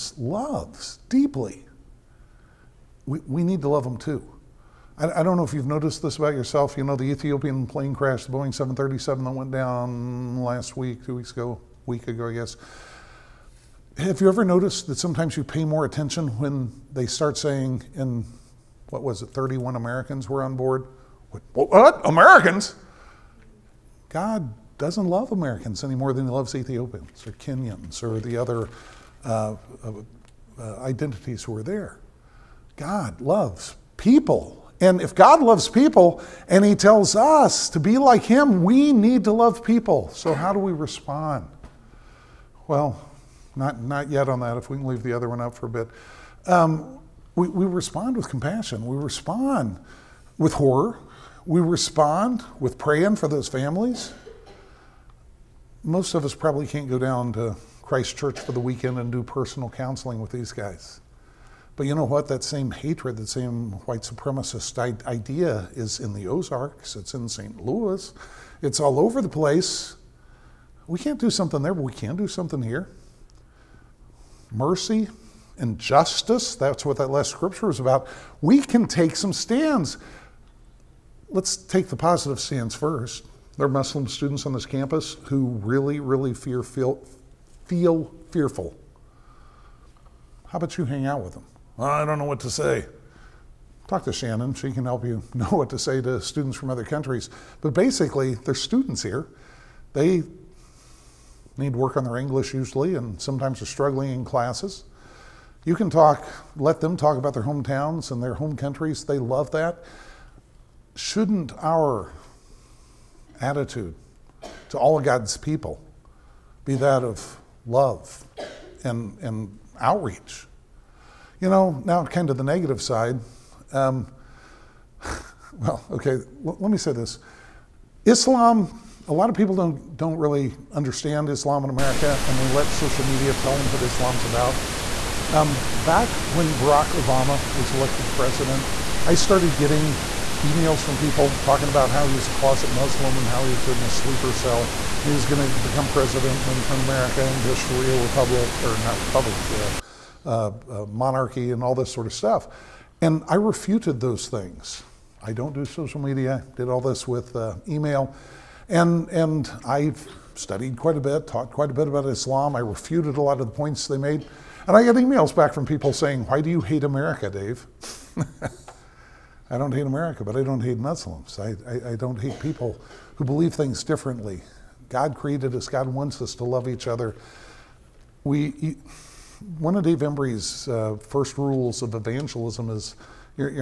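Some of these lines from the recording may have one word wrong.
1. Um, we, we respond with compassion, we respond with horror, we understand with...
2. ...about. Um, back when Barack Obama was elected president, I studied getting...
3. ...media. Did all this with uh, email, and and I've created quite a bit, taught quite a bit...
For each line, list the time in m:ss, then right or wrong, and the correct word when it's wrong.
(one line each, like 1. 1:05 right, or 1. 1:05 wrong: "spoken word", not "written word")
1. 0:46 wrong: "respond", not "understand"
2. 2:14 wrong: "started", not "studied"
3. 2:36 wrong: "studied", not "created".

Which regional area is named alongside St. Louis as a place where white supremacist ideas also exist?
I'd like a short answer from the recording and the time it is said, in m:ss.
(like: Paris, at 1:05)
the Ozarks, at 1:06.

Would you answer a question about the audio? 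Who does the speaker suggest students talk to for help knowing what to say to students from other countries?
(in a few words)
Shannon.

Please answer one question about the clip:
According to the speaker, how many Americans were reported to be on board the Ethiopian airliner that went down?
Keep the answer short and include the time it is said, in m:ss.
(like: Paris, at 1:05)
31, at 0:19.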